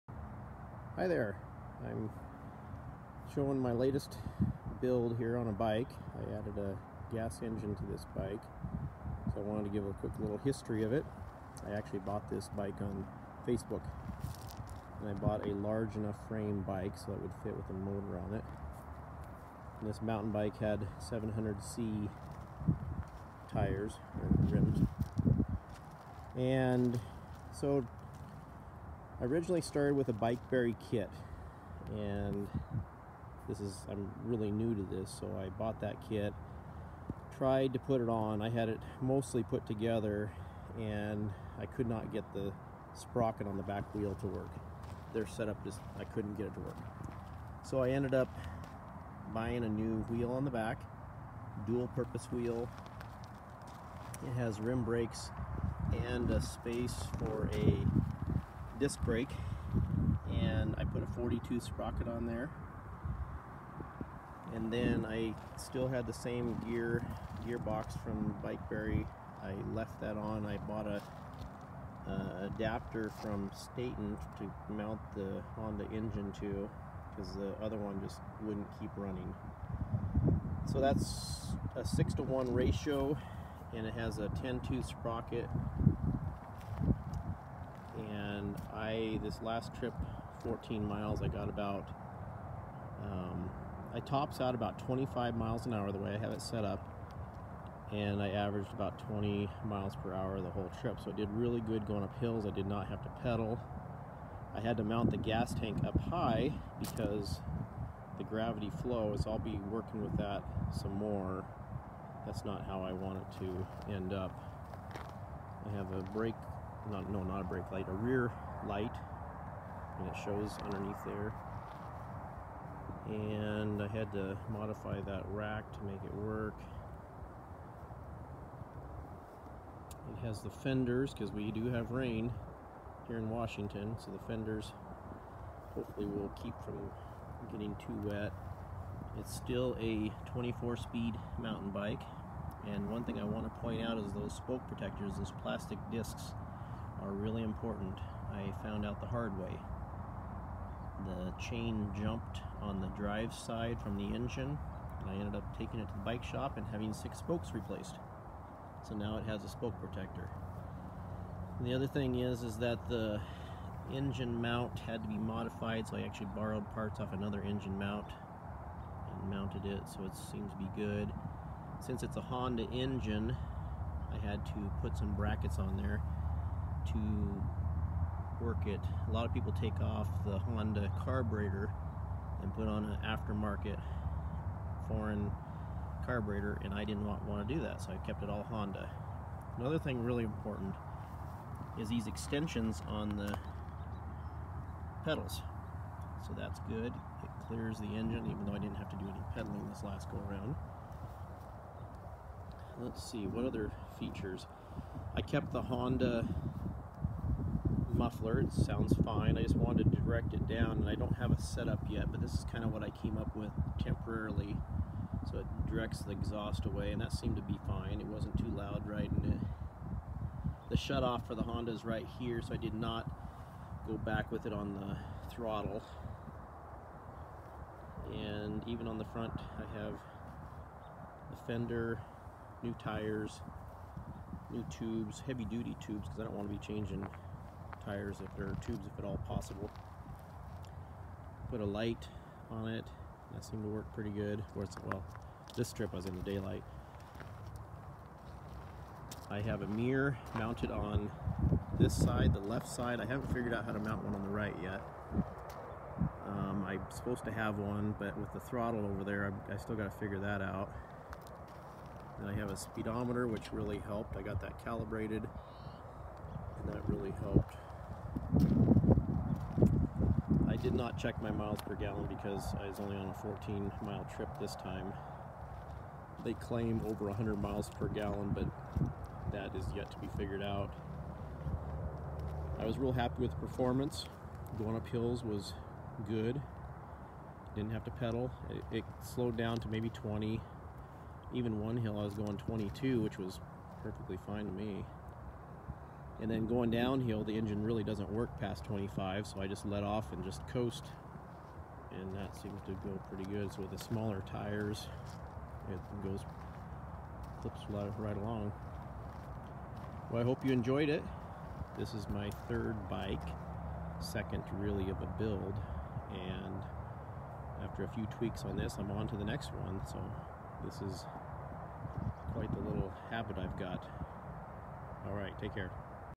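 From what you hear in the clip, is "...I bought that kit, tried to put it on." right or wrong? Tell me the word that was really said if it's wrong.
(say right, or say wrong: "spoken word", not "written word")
right.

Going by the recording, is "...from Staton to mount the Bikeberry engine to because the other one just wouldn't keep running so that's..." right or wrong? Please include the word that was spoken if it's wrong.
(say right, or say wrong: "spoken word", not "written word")
wrong: "Honda", not "Bikeberry".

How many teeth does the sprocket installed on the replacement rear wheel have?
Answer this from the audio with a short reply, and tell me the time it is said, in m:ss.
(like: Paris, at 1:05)
42, at 1:01.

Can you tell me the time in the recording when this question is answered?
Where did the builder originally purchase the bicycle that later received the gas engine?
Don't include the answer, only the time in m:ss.
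0:13.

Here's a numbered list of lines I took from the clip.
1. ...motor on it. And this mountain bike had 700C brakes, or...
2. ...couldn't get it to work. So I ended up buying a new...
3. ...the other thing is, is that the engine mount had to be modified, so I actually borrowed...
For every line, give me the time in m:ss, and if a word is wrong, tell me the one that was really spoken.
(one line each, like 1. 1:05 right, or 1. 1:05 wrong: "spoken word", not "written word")
1. 0:17 wrong: "tires", not "brakes"
2. 0:46 right
3. 2:41 right.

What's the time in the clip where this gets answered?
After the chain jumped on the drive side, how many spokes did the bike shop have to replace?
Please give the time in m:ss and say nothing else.
2:36.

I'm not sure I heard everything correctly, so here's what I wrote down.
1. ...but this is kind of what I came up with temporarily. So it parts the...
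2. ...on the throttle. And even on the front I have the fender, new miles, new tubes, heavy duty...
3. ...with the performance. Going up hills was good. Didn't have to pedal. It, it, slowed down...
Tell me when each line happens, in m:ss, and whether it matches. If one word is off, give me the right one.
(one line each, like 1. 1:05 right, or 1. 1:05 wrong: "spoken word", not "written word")
1. 3:32 wrong: "directs", not "parts"
2. 3:44 wrong: "tires", not "miles"
3. 4:43 right.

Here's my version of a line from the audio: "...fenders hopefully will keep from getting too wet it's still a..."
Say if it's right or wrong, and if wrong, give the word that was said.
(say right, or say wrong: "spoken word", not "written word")
right.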